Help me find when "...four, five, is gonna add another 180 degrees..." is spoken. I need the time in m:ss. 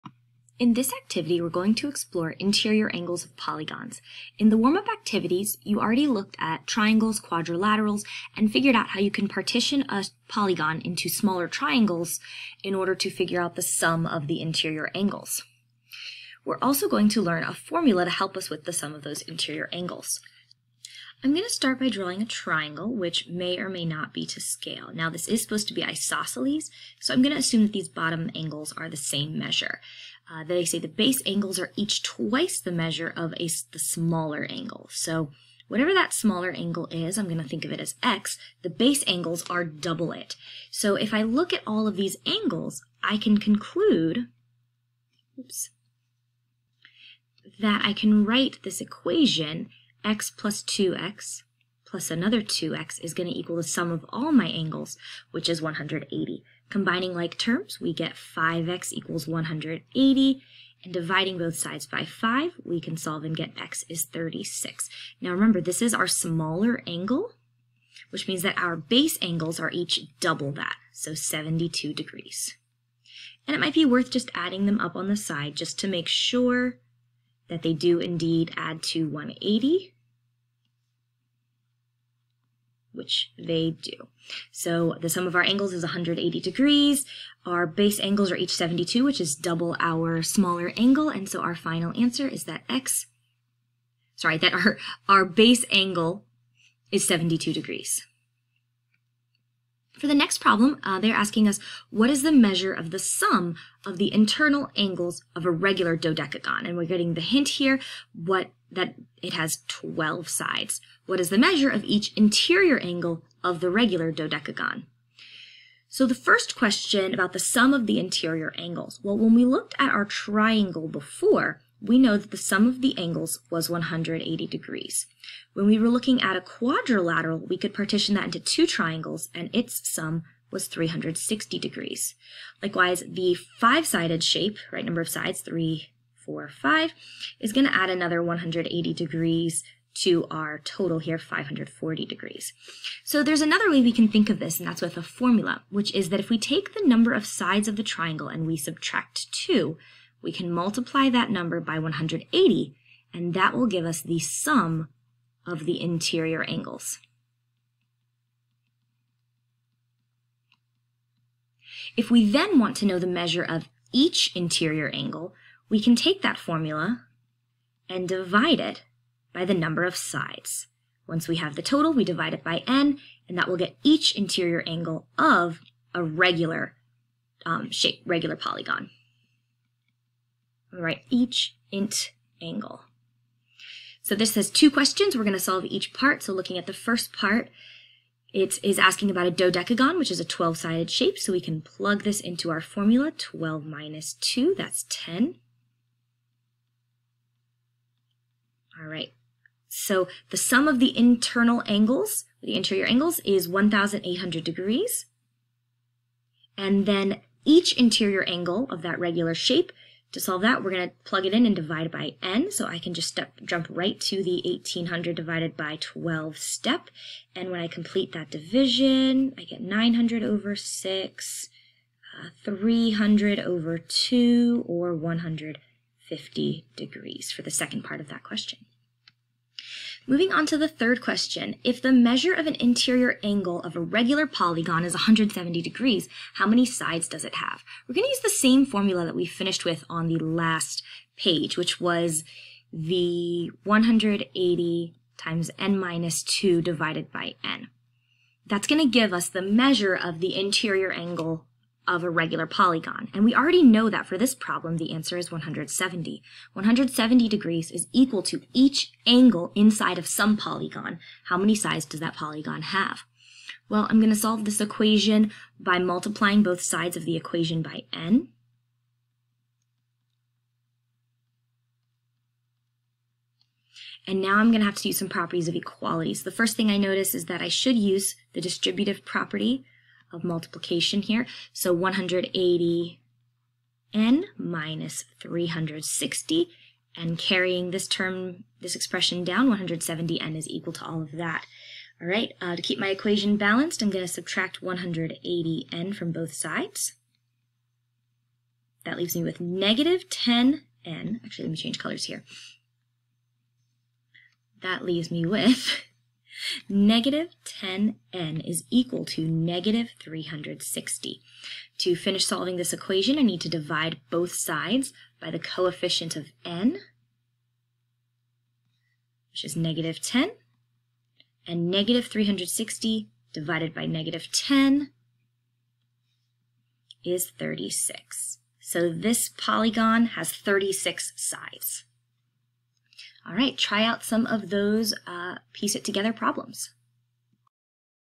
2:16.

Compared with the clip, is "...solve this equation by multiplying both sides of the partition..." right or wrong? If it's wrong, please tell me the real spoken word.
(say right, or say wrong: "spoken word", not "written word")
wrong: "equation", not "partition".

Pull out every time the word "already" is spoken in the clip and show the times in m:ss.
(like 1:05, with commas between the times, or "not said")
0:05, 4:13.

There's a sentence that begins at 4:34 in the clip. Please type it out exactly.
And now I'm going to have to use some properties of equality.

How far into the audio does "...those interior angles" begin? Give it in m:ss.
0:19.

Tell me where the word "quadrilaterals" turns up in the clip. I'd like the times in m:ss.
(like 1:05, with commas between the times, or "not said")
0:07, 2:06.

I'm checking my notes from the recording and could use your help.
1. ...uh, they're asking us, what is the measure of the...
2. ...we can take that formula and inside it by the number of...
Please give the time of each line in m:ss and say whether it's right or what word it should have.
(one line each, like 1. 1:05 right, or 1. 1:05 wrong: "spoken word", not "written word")
1. 1:40 right
2. 2:45 wrong: "divide", not "inside".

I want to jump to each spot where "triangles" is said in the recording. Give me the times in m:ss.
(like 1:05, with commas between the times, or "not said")
0:06, 0:11, 0:22, 2:00, 2:08, 2:27.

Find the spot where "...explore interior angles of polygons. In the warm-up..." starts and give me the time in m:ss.
0:01.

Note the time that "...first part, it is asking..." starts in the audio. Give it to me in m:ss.
3:06.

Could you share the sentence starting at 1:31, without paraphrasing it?
And so our final answer is that x, sorry, that our, our base angle is 72 degrees.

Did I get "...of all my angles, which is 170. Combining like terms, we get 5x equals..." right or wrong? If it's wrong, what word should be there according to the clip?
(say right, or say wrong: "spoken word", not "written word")
wrong: "180", not "170".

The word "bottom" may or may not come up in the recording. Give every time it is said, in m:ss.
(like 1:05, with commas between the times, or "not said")
0:27.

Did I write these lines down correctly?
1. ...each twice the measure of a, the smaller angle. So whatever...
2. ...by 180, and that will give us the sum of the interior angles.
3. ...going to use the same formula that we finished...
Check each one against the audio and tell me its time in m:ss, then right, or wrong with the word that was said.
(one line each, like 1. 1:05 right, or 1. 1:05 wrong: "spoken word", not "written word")
1. 0:31 right
2. 2:31 right
3. 3:57 right.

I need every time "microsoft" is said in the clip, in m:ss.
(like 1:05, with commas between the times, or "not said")
not said.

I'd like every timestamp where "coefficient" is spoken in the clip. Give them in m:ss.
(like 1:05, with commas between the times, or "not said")
5:15.